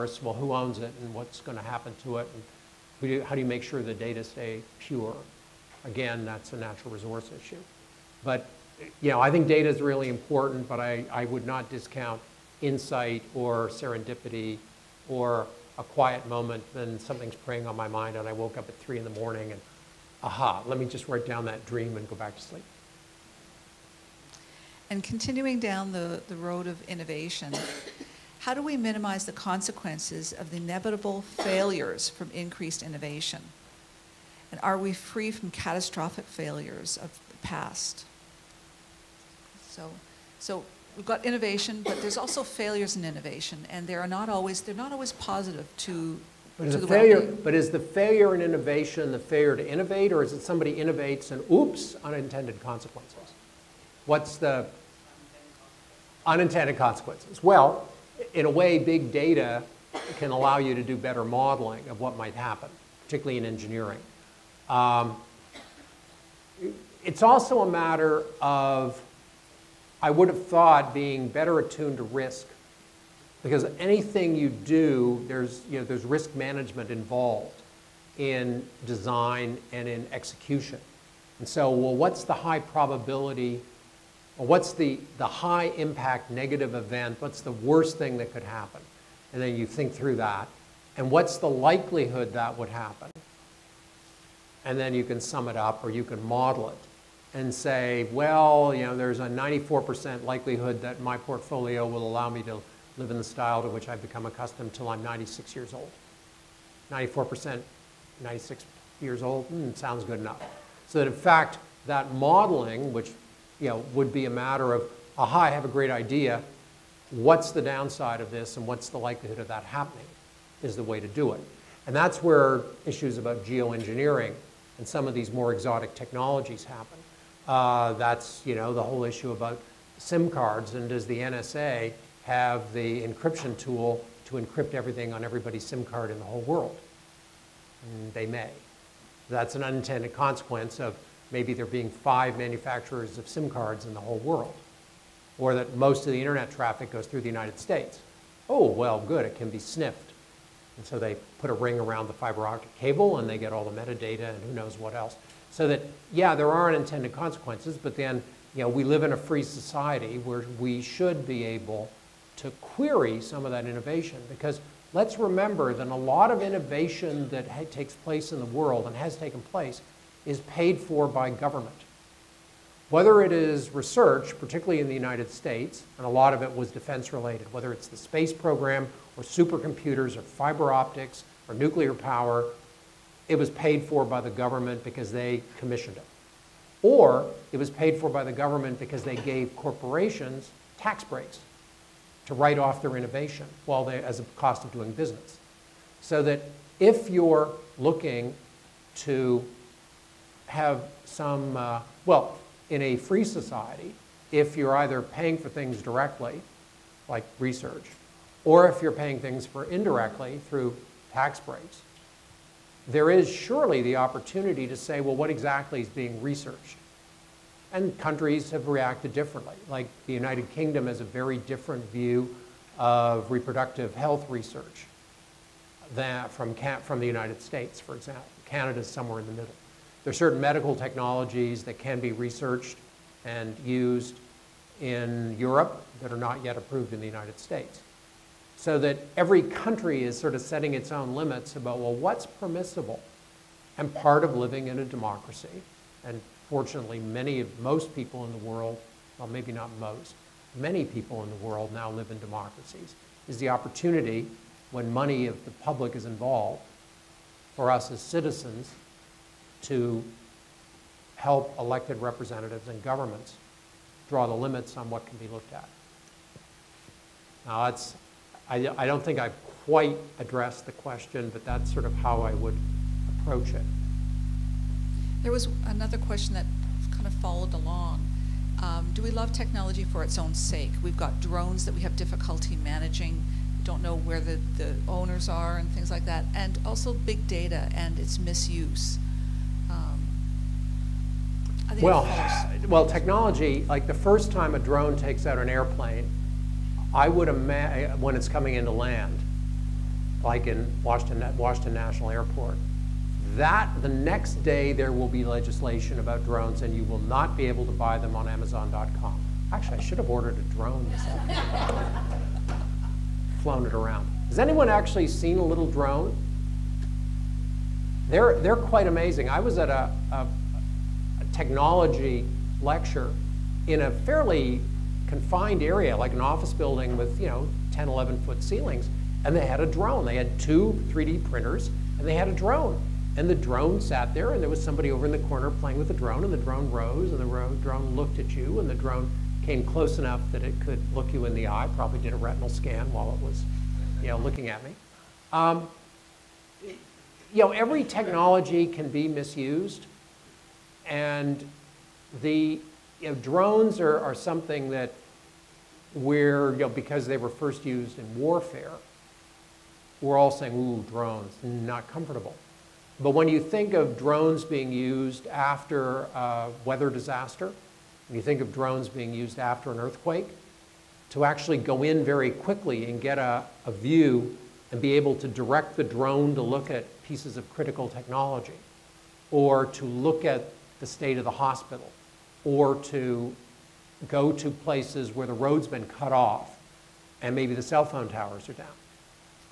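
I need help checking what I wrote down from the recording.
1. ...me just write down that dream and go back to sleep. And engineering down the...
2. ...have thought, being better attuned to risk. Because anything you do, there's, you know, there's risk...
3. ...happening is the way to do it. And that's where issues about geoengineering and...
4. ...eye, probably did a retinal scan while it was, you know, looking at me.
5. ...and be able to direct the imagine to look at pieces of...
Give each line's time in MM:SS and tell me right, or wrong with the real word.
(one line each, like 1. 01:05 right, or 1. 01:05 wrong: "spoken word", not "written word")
1. 00:20 wrong: "continuing", not "engineering"
2. 01:10 right
3. 01:59 right
4. 05:41 right
5. 06:14 wrong: "drone", not "imagine".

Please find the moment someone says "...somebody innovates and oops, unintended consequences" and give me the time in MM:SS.
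00:50.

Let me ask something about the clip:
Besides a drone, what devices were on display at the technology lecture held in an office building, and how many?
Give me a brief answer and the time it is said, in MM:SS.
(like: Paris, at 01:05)
two 3D printers, at 05:30.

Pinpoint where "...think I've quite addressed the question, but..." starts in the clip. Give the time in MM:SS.
04:29.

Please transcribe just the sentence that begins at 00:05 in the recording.
Again, that's a natural resource issue.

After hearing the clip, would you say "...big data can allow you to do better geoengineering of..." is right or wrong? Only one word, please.
wrong.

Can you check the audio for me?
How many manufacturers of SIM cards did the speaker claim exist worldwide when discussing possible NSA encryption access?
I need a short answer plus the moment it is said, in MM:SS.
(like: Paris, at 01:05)
5, at 02:21.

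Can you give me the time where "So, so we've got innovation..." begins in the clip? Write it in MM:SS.
00:39.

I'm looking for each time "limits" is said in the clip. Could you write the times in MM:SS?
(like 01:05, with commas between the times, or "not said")
04:01, 04:24.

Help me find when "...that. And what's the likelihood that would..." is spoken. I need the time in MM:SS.
01:30.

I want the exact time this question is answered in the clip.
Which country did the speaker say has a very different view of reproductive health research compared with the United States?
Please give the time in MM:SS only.
03:40.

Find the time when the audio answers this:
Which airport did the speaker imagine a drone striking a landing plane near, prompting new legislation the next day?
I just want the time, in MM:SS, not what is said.
05:01.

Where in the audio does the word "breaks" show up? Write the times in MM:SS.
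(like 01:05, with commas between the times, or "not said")
03:11, 03:31.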